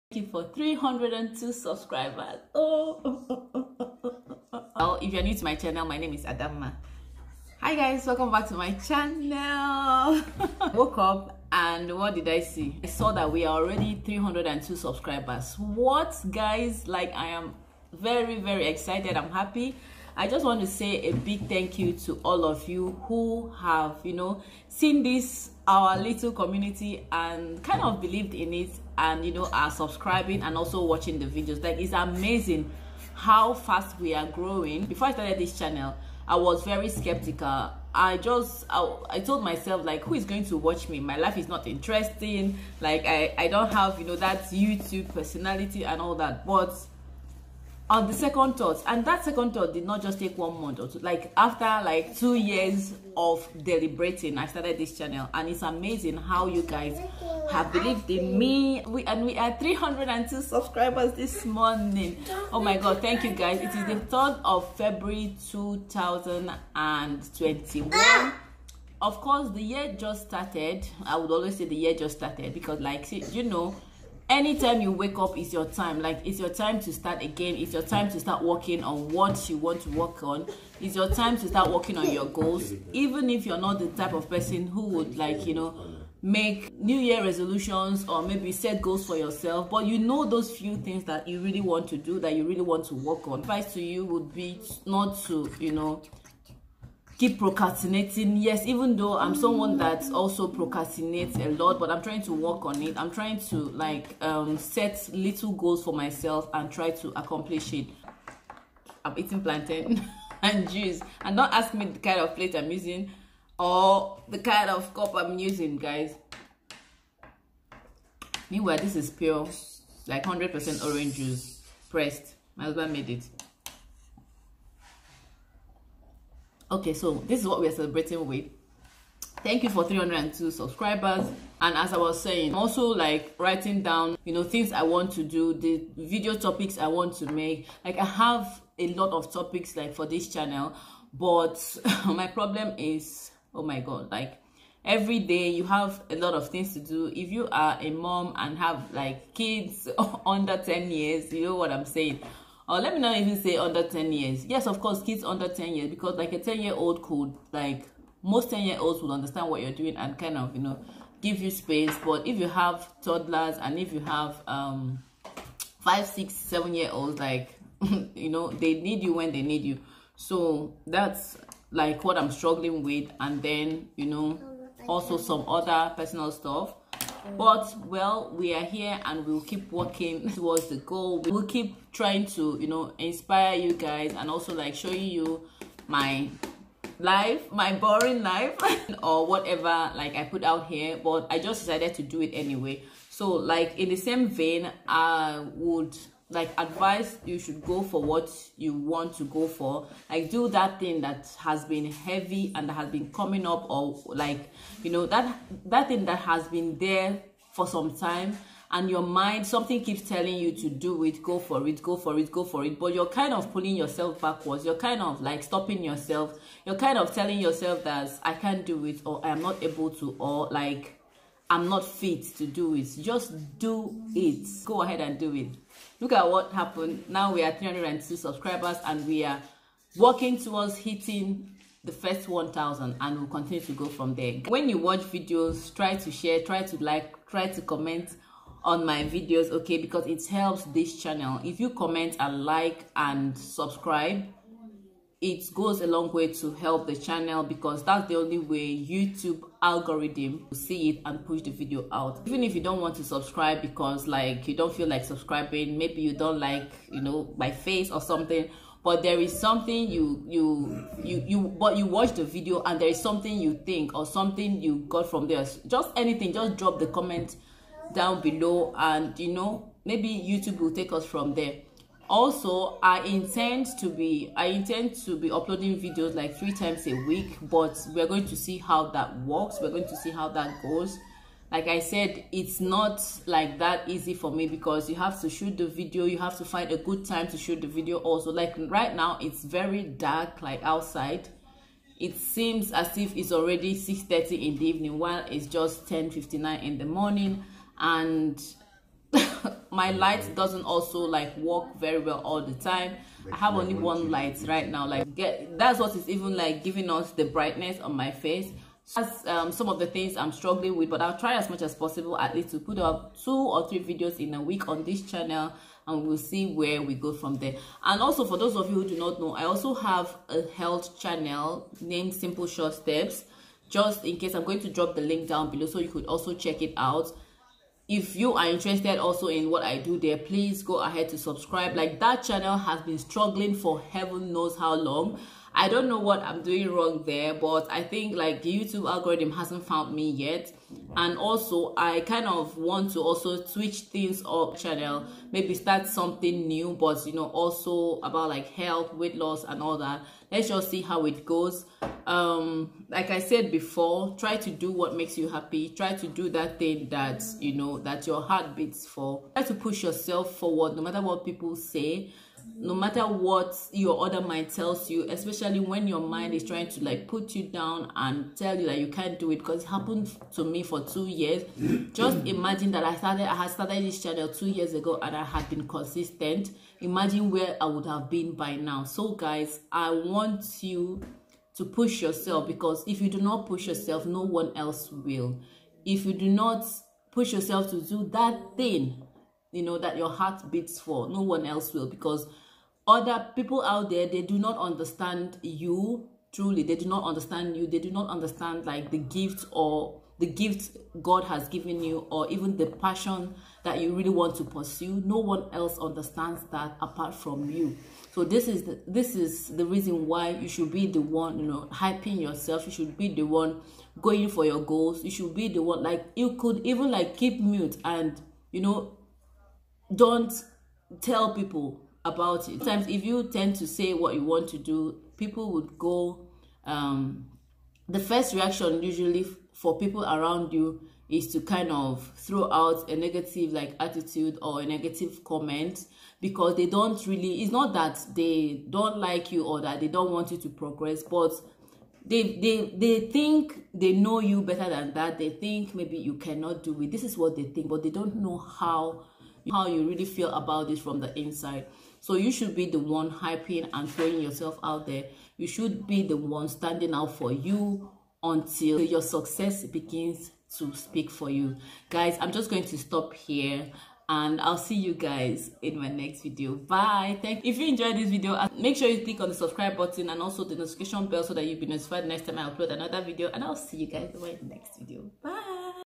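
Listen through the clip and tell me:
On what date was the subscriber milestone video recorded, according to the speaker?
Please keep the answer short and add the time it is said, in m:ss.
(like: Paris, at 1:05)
3rd of February 2021, at 1:04.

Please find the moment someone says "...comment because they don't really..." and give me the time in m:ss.
7:15.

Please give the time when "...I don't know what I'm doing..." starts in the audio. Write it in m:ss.
5:35.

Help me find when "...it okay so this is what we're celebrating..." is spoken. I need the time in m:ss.
2:03.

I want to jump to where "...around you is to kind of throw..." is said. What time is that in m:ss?
7:10.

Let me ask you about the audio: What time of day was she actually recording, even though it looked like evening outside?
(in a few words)
10:59 in the morning.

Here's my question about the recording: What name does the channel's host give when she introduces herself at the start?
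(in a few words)
Adama.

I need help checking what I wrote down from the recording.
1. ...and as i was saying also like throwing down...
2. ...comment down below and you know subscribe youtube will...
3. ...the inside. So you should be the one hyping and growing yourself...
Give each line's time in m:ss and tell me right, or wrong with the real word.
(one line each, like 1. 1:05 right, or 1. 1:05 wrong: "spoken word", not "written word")
1. 2:11 wrong: "writing", not "throwing"
2. 4:26 wrong: "maybe", not "subscribe"
3. 7:30 wrong: "throwing", not "growing".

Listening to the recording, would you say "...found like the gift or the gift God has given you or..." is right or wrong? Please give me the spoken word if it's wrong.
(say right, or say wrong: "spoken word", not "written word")
wrong: "understand", not "found".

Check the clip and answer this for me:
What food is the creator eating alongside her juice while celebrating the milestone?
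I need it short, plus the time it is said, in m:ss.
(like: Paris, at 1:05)
Plantain, at 1:49.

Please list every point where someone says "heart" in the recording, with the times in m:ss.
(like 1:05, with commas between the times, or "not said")
5:58, 6:30.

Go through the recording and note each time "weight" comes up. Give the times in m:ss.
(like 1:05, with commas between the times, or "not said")
5:48.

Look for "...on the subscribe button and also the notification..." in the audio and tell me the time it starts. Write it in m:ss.
7:49.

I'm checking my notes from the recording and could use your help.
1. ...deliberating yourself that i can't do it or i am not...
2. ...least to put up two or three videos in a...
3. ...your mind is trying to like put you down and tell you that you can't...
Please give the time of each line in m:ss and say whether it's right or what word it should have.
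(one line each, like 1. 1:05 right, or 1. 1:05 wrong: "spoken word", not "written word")
1. 3:37 wrong: "telling", not "deliberating"
2. 5:12 right
3. 6:05 right.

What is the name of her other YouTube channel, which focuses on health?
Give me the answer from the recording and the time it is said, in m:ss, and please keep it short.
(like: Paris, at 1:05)
Simple Short Steps, at 5:22.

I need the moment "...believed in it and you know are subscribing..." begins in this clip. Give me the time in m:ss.
0:28.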